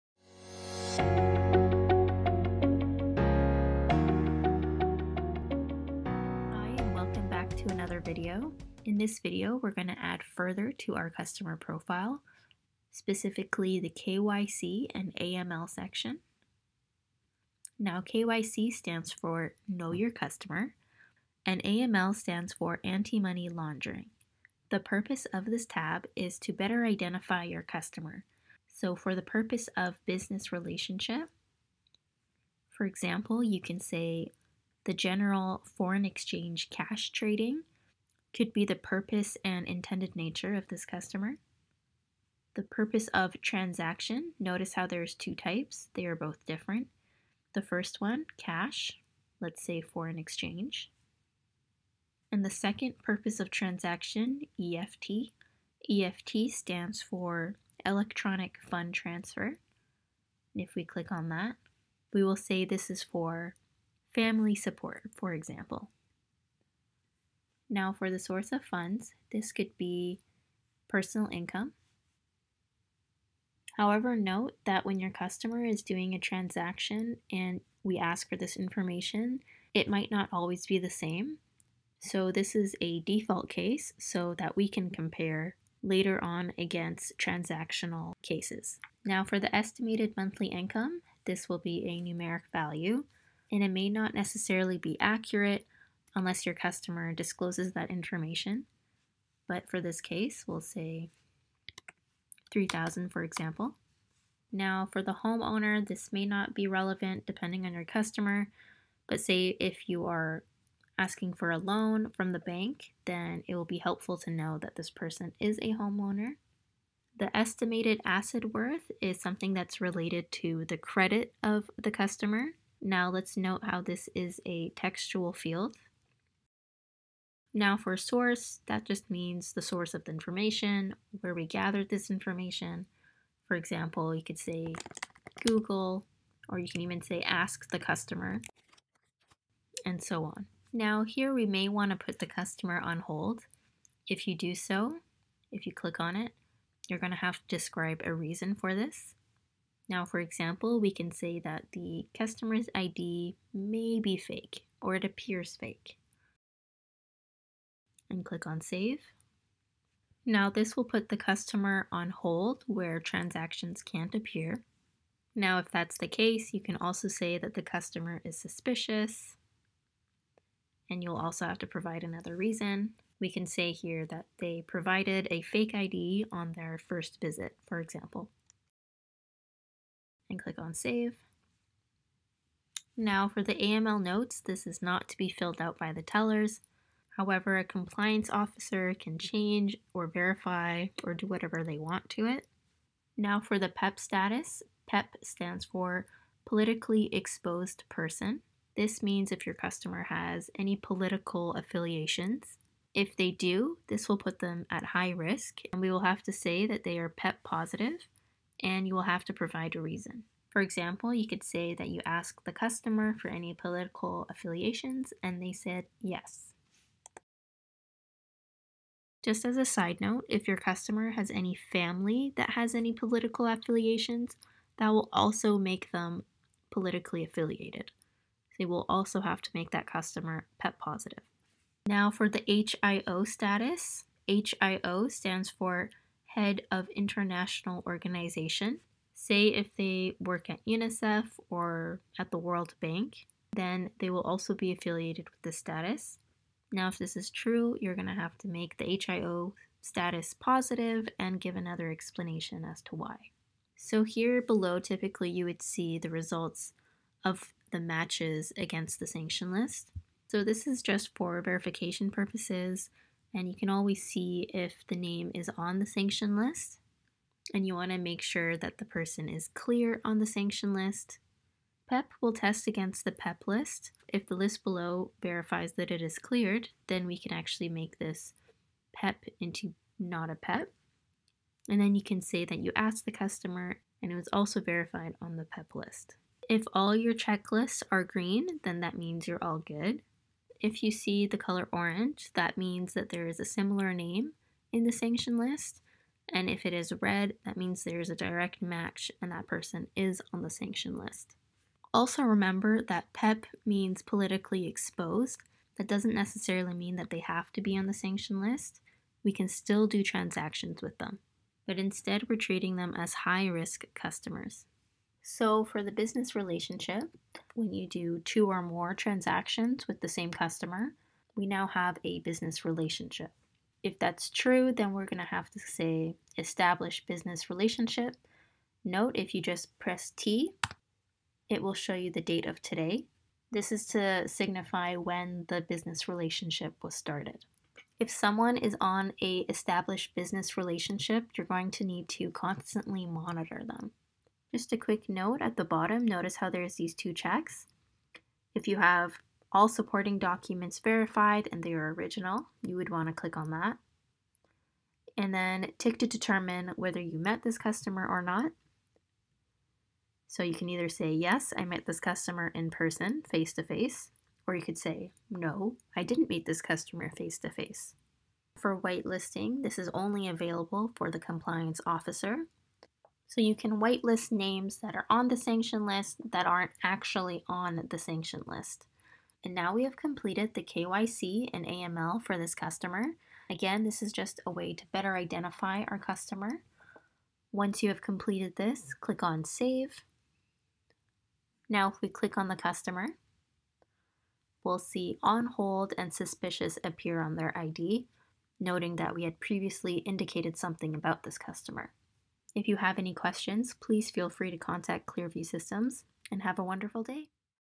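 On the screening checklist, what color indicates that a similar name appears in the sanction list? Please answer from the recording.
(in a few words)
orange.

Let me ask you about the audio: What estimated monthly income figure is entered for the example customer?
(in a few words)
3000.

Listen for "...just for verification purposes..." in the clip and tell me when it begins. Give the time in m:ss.
4:20.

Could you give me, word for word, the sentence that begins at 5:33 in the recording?
This is to signify when the business relationship was started.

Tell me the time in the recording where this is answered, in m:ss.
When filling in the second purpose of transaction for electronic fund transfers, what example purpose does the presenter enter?
1:04.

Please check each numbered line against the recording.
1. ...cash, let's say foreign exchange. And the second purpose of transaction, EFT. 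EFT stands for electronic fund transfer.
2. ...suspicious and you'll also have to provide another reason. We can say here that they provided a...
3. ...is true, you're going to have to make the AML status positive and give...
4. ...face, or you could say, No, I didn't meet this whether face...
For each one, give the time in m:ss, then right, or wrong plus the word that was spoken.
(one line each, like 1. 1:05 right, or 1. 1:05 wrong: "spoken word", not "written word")
1. 0:48 right
2. 2:48 right
3. 4:07 wrong: "HIO", not "AML"
4. 6:03 wrong: "customer", not "whether".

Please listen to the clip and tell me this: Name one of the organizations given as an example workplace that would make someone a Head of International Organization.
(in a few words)
UNICEF.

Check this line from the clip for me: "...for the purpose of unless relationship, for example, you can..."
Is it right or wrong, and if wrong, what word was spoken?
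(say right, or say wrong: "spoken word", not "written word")
wrong: "business", not "unless".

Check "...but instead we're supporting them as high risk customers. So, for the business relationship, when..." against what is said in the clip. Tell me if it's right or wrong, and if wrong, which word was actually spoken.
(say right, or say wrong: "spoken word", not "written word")
wrong: "treating", not "supporting".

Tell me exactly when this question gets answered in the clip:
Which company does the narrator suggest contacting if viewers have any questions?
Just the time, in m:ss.
6:45.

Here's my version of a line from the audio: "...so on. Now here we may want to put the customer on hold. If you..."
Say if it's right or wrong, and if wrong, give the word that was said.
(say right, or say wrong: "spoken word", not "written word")
right.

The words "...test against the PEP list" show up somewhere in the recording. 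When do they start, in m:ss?
4:32.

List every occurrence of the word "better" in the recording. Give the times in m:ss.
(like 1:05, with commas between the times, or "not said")
0:26, 6:24.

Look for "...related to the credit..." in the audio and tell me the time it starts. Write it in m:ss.
1:59.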